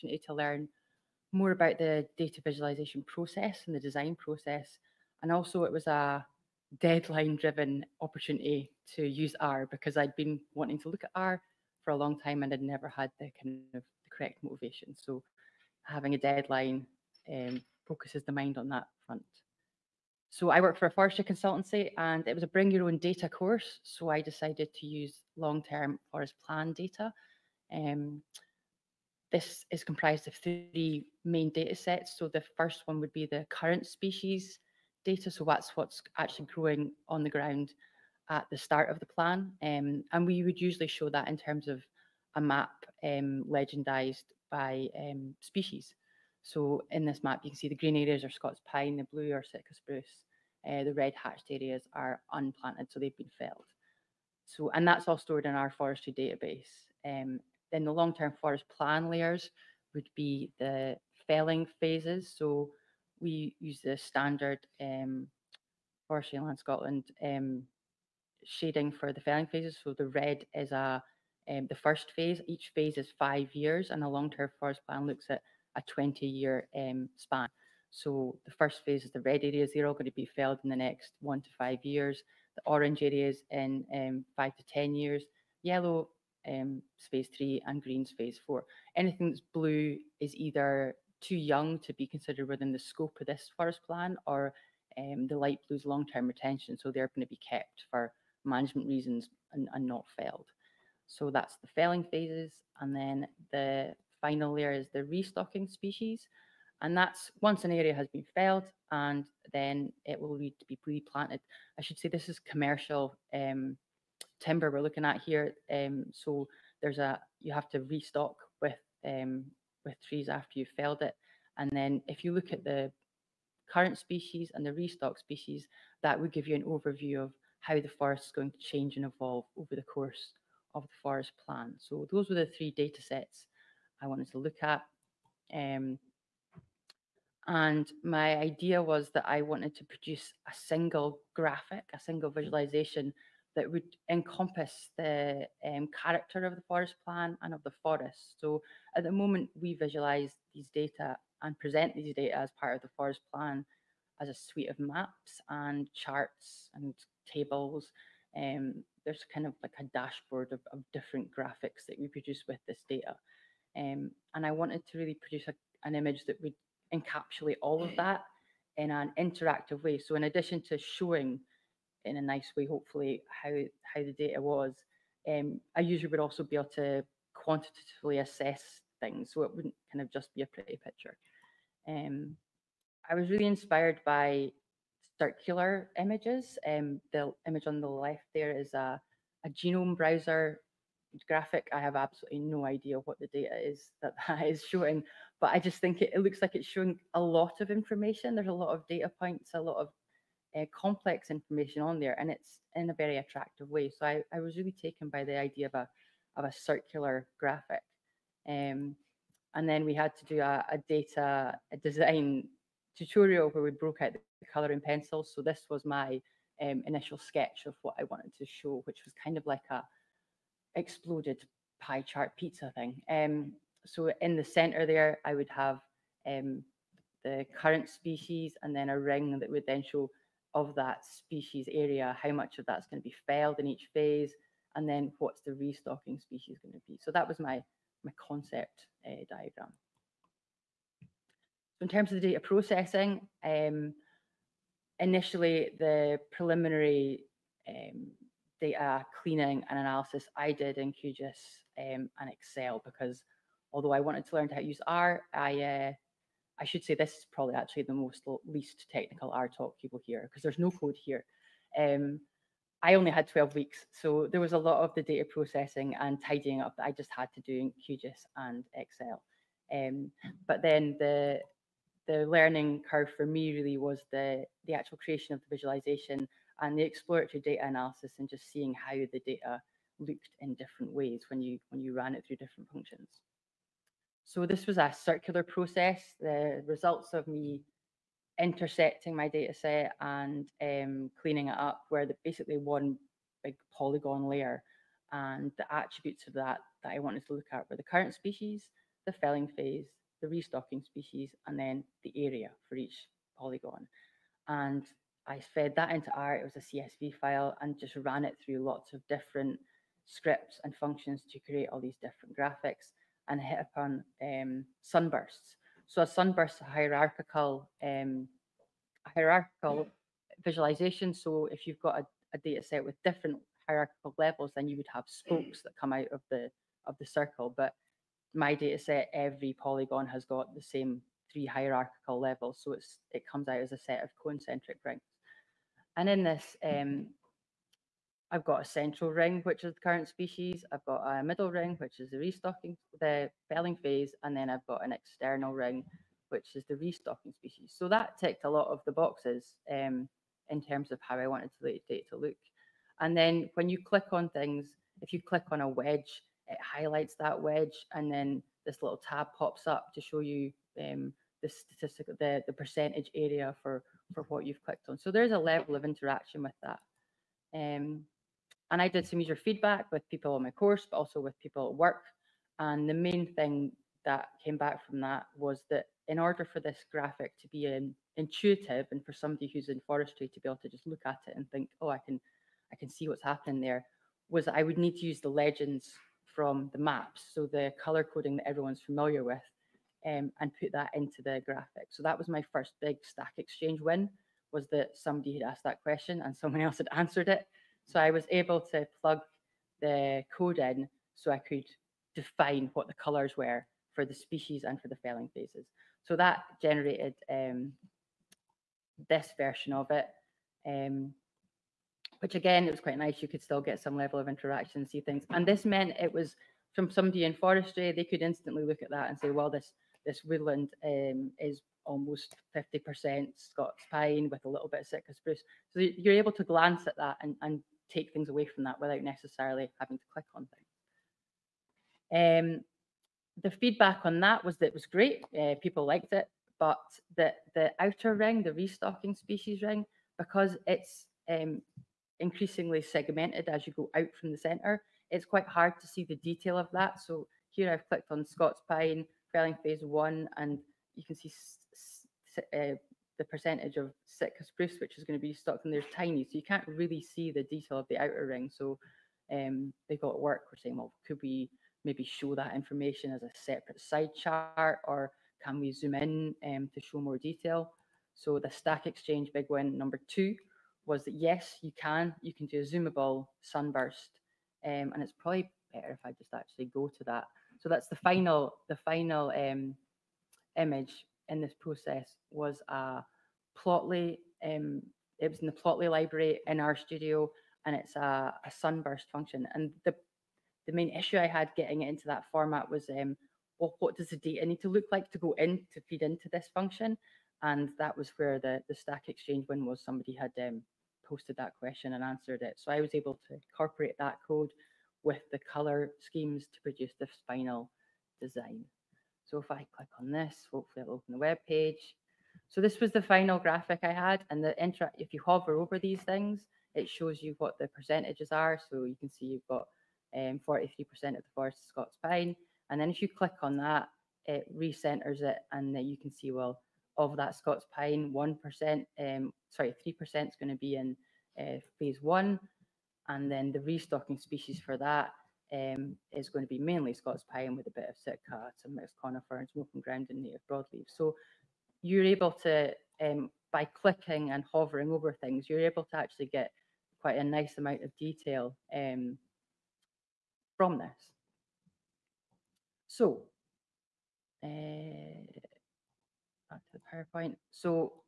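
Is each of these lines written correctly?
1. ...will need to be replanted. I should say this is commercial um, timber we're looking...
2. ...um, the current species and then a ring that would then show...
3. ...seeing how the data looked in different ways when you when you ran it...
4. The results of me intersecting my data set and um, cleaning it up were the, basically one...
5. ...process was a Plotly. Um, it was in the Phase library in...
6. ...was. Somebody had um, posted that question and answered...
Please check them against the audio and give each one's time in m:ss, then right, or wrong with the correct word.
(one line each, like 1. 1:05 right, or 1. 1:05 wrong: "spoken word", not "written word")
1. 1:50 right
2. 3:46 right
3. 4:38 right
4. 4:46 right
5. 8:01 wrong: "Plotly", not "Phase"
6. 8:19 right.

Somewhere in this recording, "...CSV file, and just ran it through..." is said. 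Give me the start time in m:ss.
5:06.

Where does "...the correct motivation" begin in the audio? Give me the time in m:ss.
0:14.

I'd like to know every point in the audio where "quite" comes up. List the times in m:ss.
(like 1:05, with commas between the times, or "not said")
6:52, 7:25, 9:07.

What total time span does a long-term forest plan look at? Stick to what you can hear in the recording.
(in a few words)
20 years.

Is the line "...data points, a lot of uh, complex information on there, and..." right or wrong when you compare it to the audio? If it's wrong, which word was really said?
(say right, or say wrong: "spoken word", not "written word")
right.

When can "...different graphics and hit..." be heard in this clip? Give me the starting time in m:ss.
5:12.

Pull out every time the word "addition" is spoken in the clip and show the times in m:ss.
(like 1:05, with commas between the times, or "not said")
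2:50.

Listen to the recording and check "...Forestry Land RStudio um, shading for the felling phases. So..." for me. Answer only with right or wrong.
wrong.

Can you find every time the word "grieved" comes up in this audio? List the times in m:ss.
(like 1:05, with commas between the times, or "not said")
not said.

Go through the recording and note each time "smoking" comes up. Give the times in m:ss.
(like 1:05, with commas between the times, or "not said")
8:59.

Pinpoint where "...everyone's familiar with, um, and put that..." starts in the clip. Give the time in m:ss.
6:28.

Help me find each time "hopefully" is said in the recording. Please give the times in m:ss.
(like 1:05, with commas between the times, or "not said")
2:52, 8:30.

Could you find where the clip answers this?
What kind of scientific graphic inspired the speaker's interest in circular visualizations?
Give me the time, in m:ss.
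3:09.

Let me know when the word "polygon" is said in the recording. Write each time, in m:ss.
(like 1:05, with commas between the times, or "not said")
4:53, 5:03, 5:29.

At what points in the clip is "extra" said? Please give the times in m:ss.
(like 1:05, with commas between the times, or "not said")
not said.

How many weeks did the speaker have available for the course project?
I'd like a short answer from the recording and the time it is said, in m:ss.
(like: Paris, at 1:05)
12, at 4:23.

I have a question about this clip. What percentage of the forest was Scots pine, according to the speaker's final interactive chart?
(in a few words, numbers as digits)
43%.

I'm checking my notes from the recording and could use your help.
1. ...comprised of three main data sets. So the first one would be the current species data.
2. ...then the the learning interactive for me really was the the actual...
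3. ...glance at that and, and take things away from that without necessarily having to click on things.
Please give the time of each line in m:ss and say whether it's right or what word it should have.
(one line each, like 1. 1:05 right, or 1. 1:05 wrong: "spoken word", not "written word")
1. 0:29 right
2. 4:30 wrong: "curve", not "interactive"
3. 7:06 right.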